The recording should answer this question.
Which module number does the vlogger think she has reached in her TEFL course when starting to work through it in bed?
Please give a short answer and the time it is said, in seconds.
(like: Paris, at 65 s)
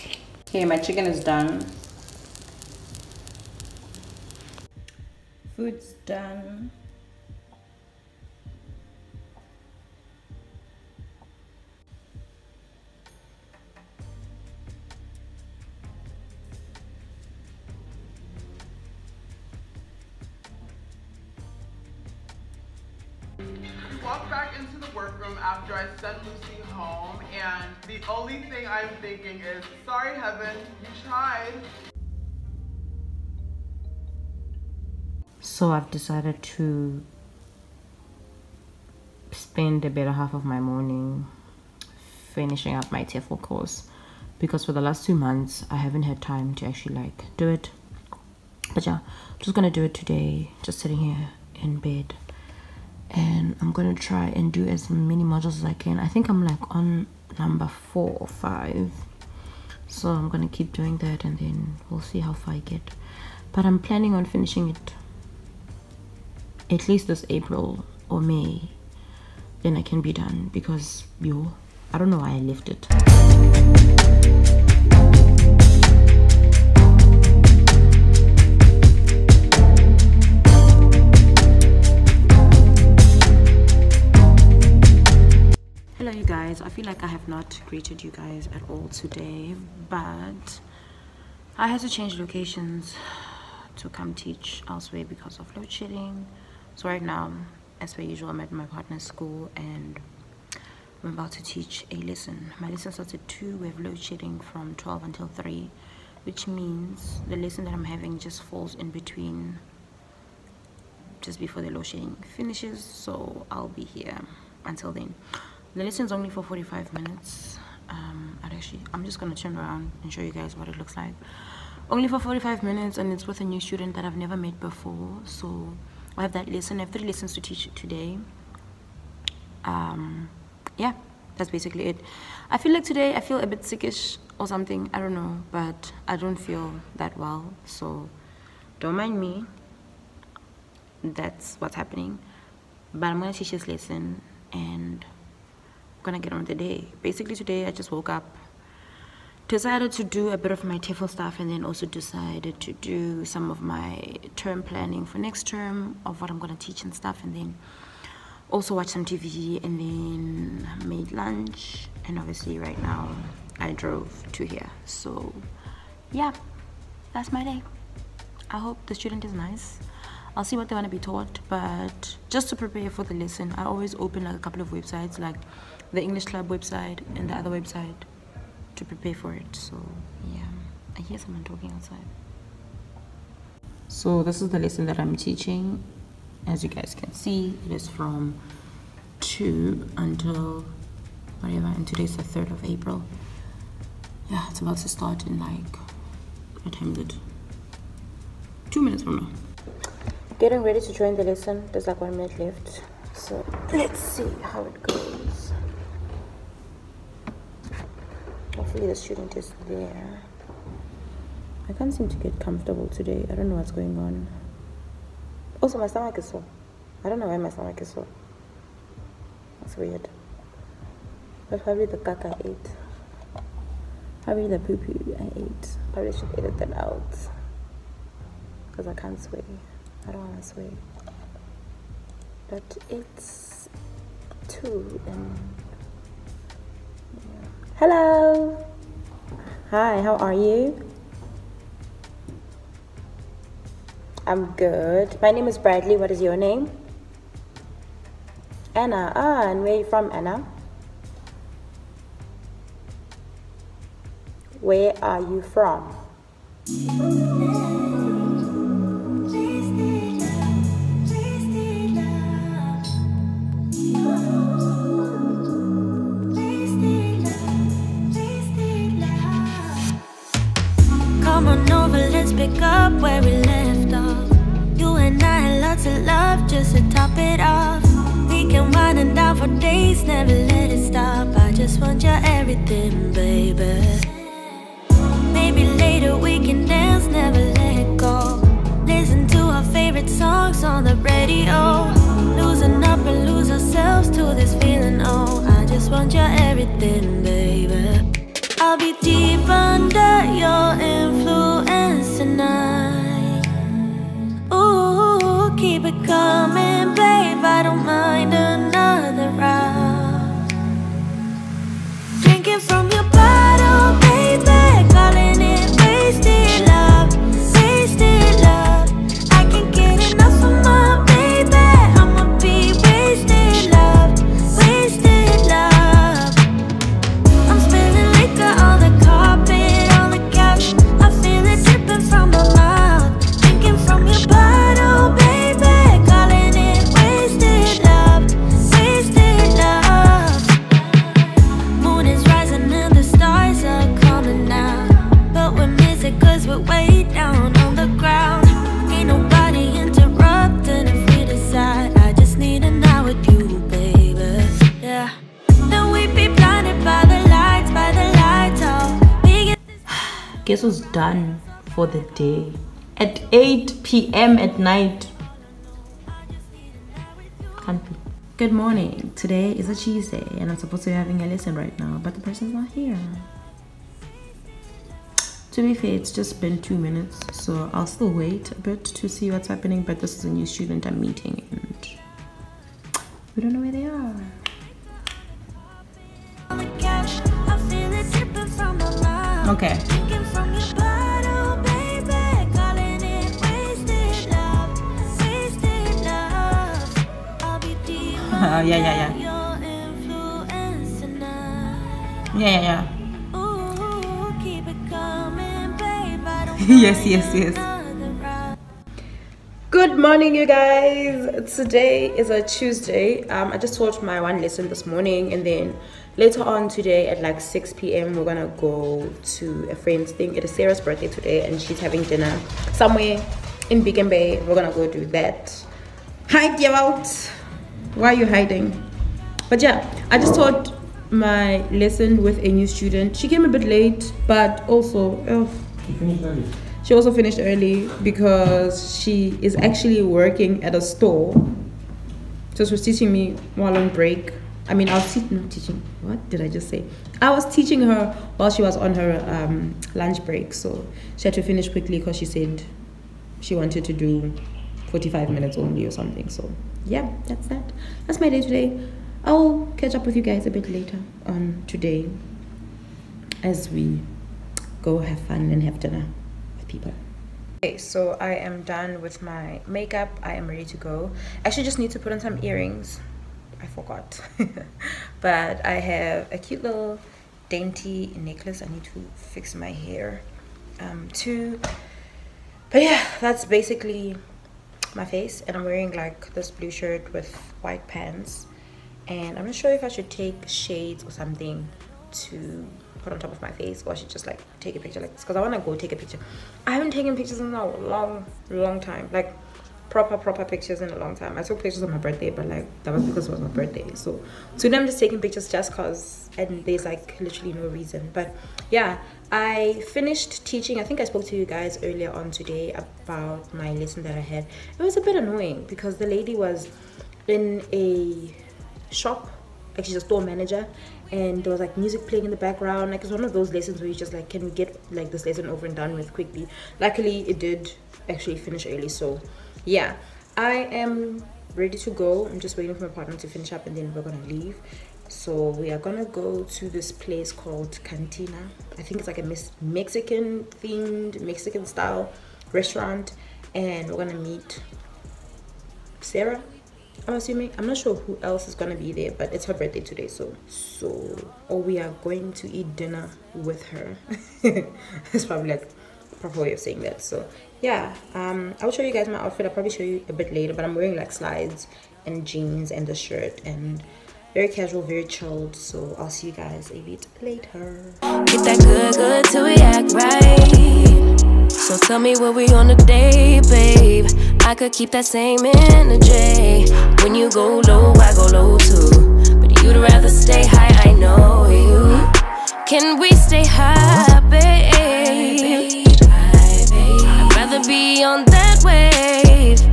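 4, at 57 s.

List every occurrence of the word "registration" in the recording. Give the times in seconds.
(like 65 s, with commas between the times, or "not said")
not said.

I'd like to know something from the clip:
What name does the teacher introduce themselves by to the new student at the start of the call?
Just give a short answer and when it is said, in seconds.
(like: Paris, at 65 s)
Bradley, at 245 s.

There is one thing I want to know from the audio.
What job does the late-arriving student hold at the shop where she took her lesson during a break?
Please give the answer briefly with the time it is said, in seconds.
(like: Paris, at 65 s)
store manager, at 520 s.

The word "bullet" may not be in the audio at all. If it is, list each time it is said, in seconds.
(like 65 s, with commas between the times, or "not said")
not said.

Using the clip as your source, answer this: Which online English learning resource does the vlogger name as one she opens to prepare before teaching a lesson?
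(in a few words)
English Club.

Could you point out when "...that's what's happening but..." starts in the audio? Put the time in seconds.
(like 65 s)
141 s.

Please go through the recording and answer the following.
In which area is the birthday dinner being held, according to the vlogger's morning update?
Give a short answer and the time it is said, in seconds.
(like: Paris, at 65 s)
Beacon Bay, at 423 s.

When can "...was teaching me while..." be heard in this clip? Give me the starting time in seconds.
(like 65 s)
442 s.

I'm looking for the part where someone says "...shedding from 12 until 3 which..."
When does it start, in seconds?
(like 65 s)
103 s.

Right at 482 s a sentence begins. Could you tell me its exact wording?
But yeah, that's basically my face.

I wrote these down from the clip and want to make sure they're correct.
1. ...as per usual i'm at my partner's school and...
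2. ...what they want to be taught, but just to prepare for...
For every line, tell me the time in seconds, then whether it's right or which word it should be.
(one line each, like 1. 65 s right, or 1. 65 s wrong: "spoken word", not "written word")
1. 97 s right
2. 170 s right.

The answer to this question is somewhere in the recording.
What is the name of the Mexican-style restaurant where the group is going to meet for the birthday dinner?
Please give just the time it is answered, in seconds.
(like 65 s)
537 s.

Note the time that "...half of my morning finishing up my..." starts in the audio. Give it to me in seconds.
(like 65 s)
40 s.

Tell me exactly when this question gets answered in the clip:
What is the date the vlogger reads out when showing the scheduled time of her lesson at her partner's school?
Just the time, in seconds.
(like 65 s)
192 s.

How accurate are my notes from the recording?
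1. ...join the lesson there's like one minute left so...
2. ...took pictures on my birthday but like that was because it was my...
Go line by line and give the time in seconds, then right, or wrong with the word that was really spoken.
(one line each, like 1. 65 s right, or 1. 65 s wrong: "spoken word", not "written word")
1. 200 s right
2. 501 s right.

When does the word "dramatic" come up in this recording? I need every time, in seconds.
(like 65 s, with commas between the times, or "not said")
not said.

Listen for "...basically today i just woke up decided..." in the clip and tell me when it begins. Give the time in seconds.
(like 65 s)
147 s.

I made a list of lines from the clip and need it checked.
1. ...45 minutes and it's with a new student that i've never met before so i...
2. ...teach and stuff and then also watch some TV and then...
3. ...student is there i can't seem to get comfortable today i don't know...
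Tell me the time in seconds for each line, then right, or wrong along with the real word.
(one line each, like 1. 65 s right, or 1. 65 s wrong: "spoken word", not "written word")
1. 122 s right
2. 156 s right
3. 208 s right.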